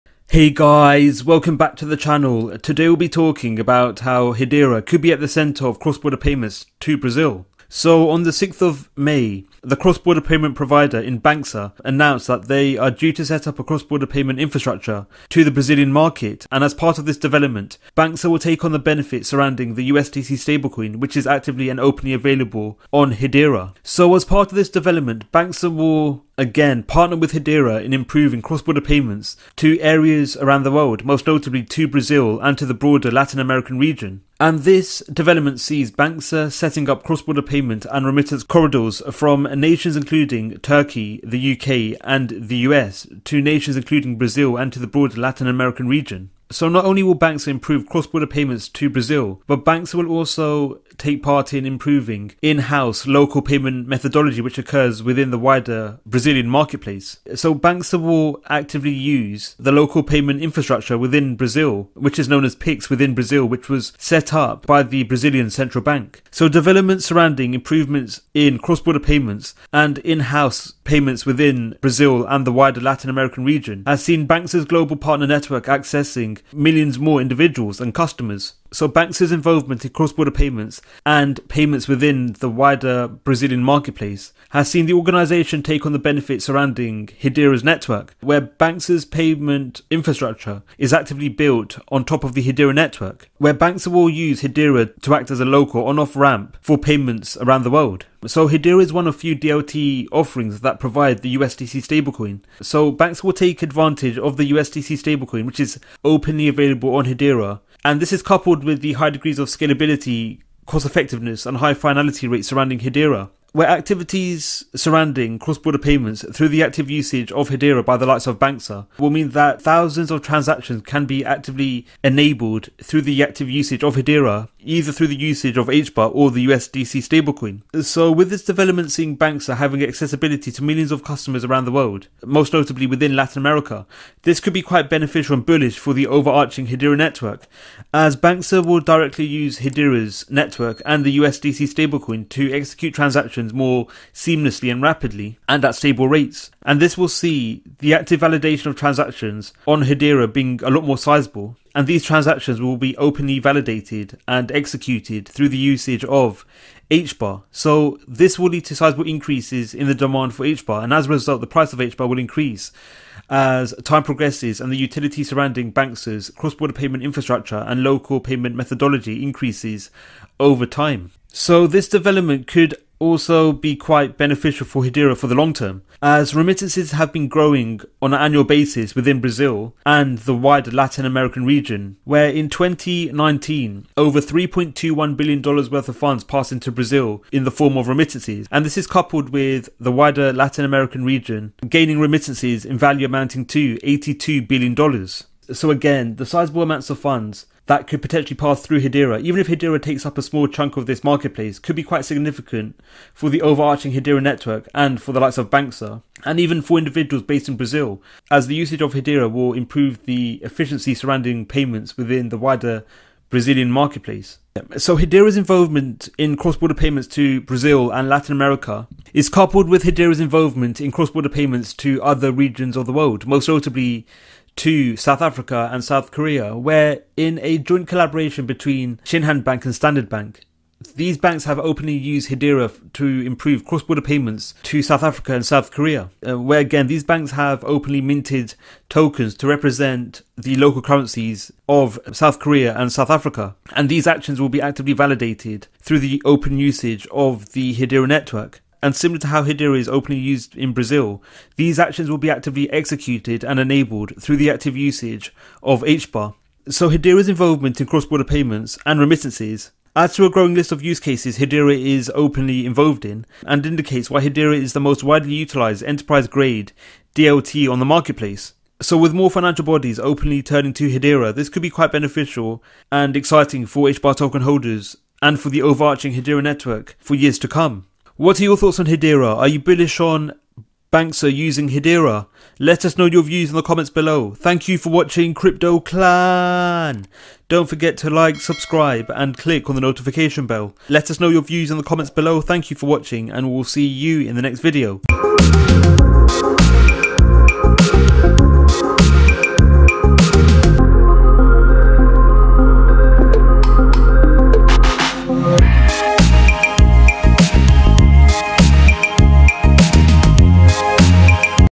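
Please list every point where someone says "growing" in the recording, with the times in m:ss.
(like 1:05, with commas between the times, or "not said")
2:57, 4:20.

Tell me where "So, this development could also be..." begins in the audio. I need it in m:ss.
2:51.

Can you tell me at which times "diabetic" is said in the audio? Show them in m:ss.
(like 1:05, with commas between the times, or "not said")
not said.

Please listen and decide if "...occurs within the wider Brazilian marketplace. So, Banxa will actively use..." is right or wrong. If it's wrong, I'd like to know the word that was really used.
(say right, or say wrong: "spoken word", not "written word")
right.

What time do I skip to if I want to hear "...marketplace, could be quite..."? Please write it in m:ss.
3:21.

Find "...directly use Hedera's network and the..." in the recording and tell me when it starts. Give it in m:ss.
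2:18.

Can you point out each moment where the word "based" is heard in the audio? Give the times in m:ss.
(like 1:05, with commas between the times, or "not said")
3:27.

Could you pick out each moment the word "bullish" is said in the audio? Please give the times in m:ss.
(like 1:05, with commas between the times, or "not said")
2:15, 4:39.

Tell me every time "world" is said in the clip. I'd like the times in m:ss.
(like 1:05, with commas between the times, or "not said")
0:30, 1:37, 2:11, 3:42.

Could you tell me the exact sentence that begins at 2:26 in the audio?
And this will see the active validation of transactions on Hedera being a lot more sizable.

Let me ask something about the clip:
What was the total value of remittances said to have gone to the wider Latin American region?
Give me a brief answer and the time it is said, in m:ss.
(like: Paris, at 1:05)
$82 billion, at 3:13.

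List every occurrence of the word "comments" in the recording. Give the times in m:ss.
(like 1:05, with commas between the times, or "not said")
4:43, 4:51.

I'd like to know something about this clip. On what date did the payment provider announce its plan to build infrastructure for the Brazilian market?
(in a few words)
6th of May.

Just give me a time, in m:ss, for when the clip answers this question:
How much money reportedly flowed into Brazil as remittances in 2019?
3:04.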